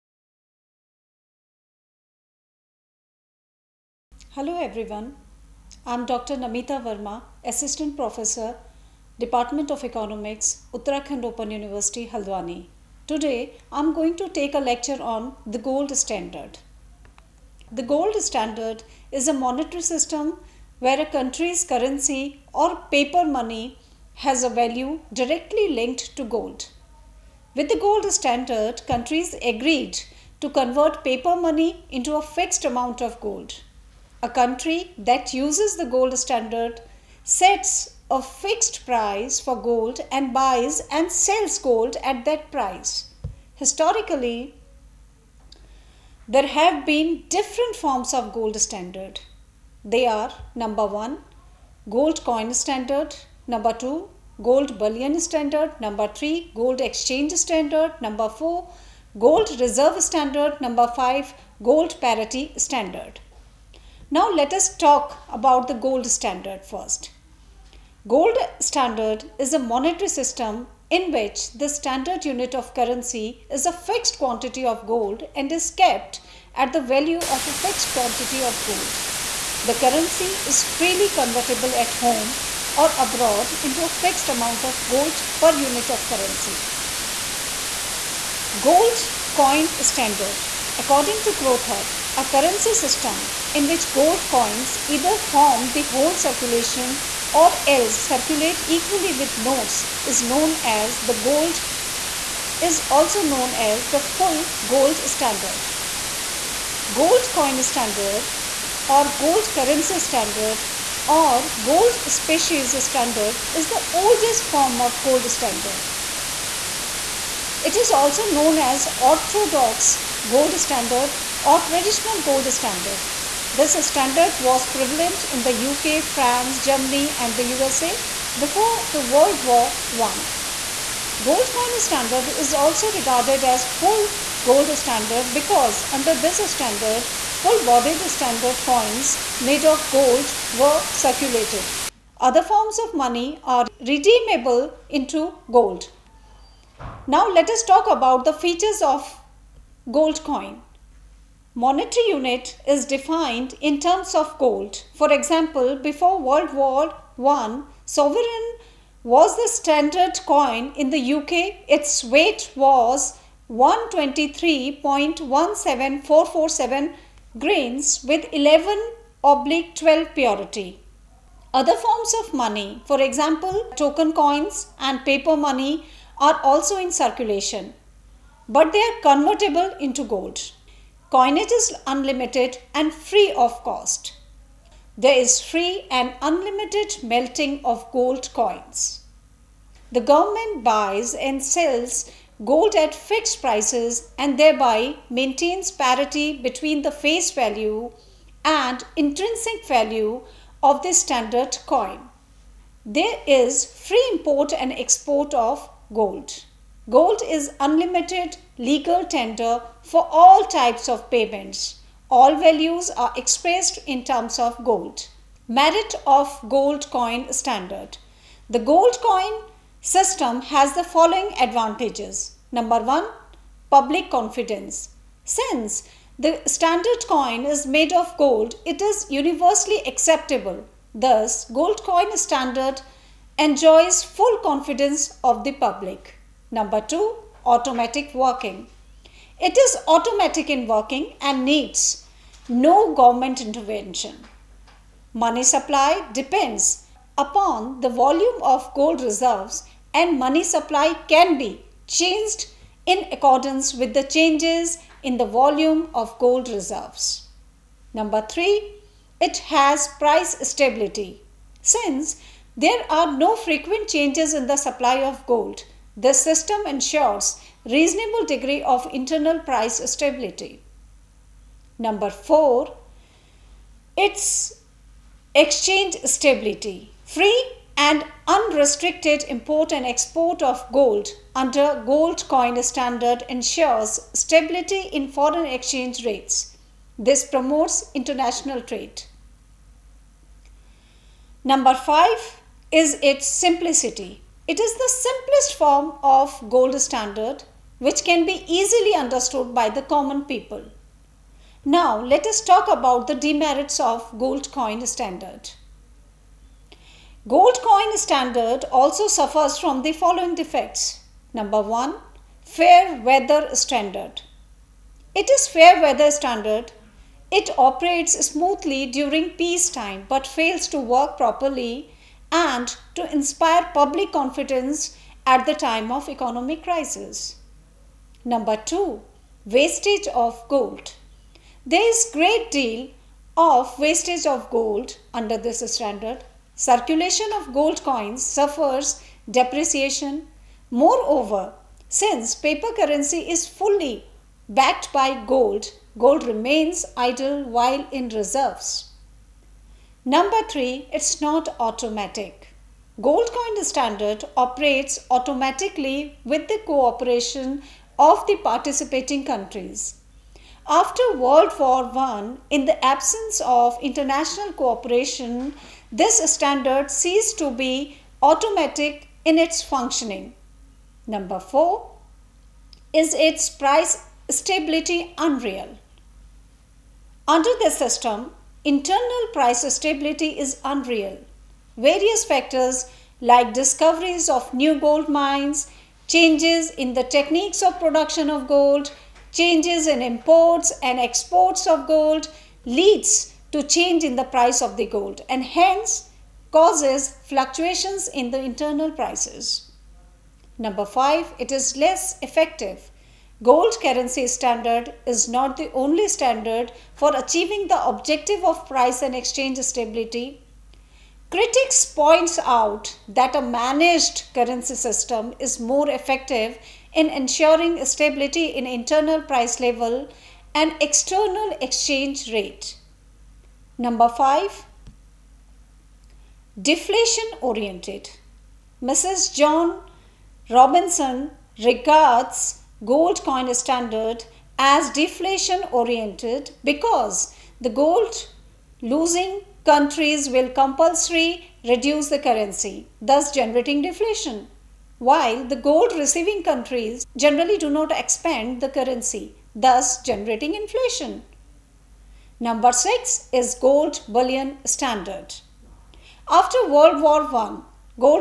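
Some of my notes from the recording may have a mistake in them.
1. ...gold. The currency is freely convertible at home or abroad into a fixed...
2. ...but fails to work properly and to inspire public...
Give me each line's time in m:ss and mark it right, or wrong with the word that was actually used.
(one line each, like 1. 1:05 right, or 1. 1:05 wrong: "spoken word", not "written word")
1. 1:18 right
2. 5:20 right.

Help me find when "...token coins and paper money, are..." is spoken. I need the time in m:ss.
2:53.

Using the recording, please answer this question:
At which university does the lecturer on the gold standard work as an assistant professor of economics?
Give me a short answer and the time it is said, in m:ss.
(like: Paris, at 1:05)
Uttarakhand Open University, at 0:10.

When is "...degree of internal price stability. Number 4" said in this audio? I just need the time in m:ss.
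4:28.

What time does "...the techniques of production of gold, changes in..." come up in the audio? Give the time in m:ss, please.
6:26.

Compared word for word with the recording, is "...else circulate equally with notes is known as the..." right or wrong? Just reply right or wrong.
right.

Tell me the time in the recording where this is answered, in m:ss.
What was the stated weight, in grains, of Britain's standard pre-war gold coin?
2:43.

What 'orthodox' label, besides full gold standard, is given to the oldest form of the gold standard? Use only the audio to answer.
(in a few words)
traditional gold standard.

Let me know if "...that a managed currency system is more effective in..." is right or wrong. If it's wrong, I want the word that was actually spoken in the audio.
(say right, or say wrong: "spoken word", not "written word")
right.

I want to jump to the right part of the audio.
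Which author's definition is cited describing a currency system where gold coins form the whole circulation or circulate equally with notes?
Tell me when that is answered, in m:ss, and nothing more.
1:31.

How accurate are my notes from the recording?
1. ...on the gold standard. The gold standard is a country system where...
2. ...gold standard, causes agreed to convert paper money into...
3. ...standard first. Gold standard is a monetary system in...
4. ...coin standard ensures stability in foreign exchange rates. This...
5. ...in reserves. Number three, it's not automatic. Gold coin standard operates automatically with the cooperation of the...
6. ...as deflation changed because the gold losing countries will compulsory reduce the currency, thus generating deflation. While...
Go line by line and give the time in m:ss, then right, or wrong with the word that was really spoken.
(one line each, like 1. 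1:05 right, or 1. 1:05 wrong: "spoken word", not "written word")
1. 0:15 wrong: "monetary", not "country"
2. 0:27 wrong: "countries", not "causes"
3. 1:06 right
4. 4:42 right
5. 5:47 right
6. 7:14 wrong: "oriented", not "changed".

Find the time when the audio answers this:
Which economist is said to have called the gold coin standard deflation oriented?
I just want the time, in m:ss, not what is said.
7:09.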